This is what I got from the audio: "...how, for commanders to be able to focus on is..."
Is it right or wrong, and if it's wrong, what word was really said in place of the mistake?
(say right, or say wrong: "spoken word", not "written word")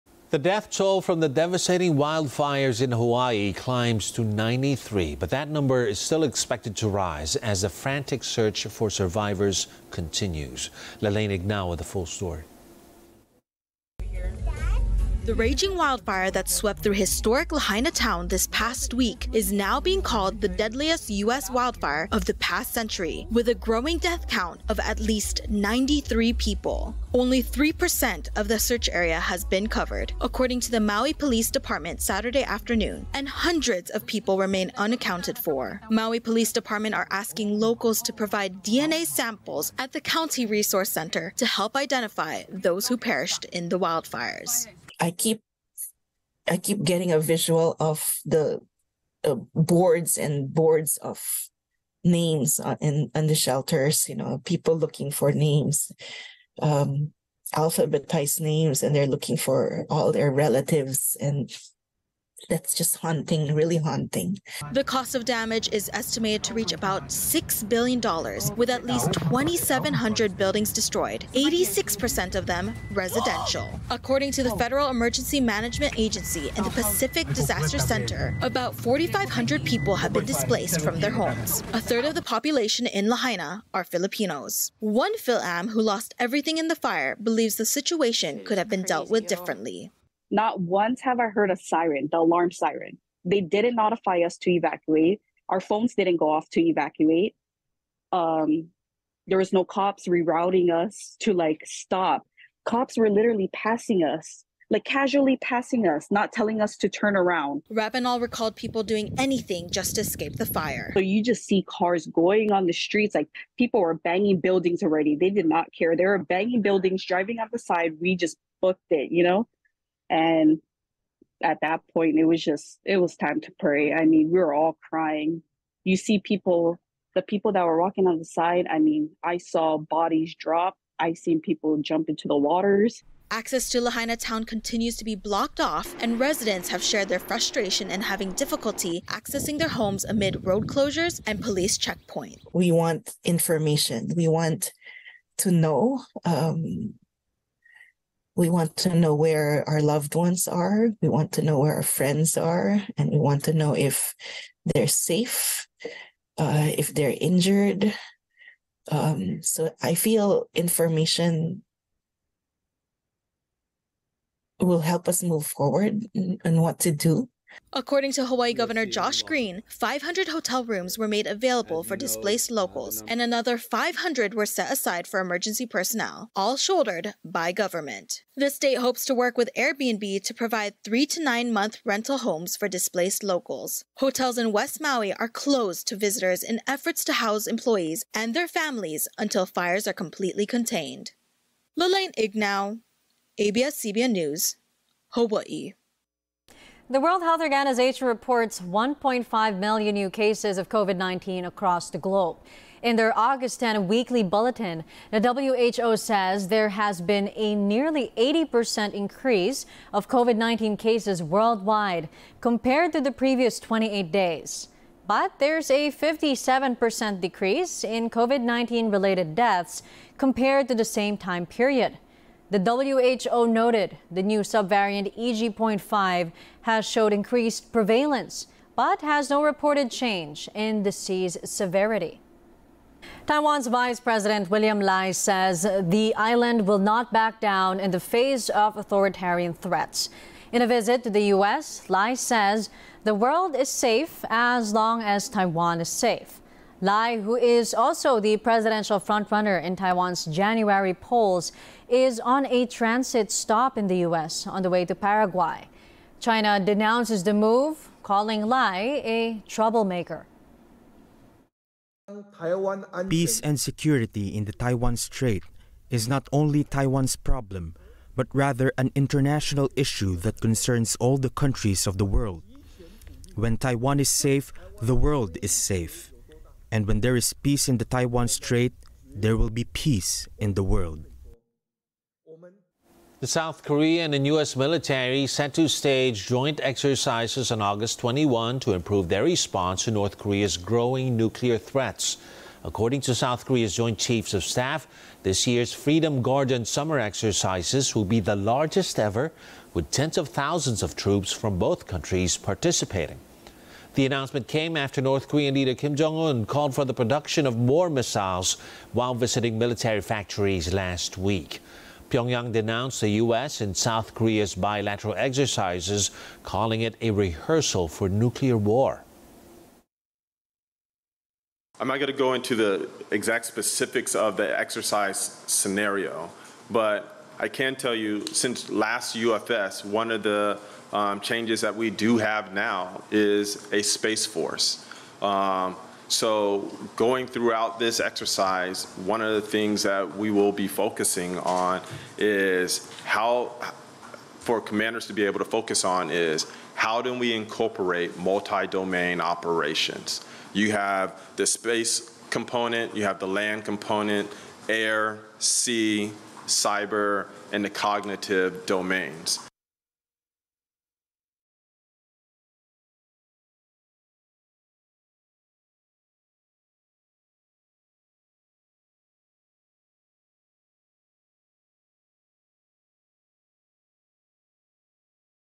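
right.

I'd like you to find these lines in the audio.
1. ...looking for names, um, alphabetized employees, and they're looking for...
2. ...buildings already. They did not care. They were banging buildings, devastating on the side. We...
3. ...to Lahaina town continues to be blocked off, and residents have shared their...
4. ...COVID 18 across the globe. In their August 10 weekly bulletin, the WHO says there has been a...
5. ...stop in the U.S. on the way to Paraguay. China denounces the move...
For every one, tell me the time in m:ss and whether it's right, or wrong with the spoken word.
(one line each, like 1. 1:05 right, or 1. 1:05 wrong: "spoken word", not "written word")
1. 0:54 wrong: "names", not "employees"
2. 1:54 wrong: "driving", not "devastating"
3. 2:13 right
4. 3:20 wrong: "19", not "18"
5. 4:13 right.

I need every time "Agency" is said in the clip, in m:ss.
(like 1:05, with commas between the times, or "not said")
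1:15.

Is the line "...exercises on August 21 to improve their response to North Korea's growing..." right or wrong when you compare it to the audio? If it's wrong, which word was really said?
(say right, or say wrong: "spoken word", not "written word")
right.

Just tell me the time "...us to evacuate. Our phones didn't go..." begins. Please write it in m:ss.
1:34.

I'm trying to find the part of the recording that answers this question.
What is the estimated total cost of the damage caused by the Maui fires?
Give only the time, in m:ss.
1:07.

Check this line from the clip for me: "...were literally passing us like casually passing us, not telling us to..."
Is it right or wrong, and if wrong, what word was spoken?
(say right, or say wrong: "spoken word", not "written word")
right.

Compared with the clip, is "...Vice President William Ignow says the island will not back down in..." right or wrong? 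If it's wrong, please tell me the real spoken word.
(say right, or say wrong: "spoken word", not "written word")
wrong: "Lai", not "Ignow".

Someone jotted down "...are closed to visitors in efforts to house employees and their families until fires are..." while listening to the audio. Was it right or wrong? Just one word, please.
right.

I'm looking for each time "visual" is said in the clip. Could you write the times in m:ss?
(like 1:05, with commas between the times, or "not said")
0:47.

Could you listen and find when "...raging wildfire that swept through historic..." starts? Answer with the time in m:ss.
0:15.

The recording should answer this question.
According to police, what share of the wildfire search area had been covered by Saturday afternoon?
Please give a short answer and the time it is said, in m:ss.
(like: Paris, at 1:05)
3%, at 0:27.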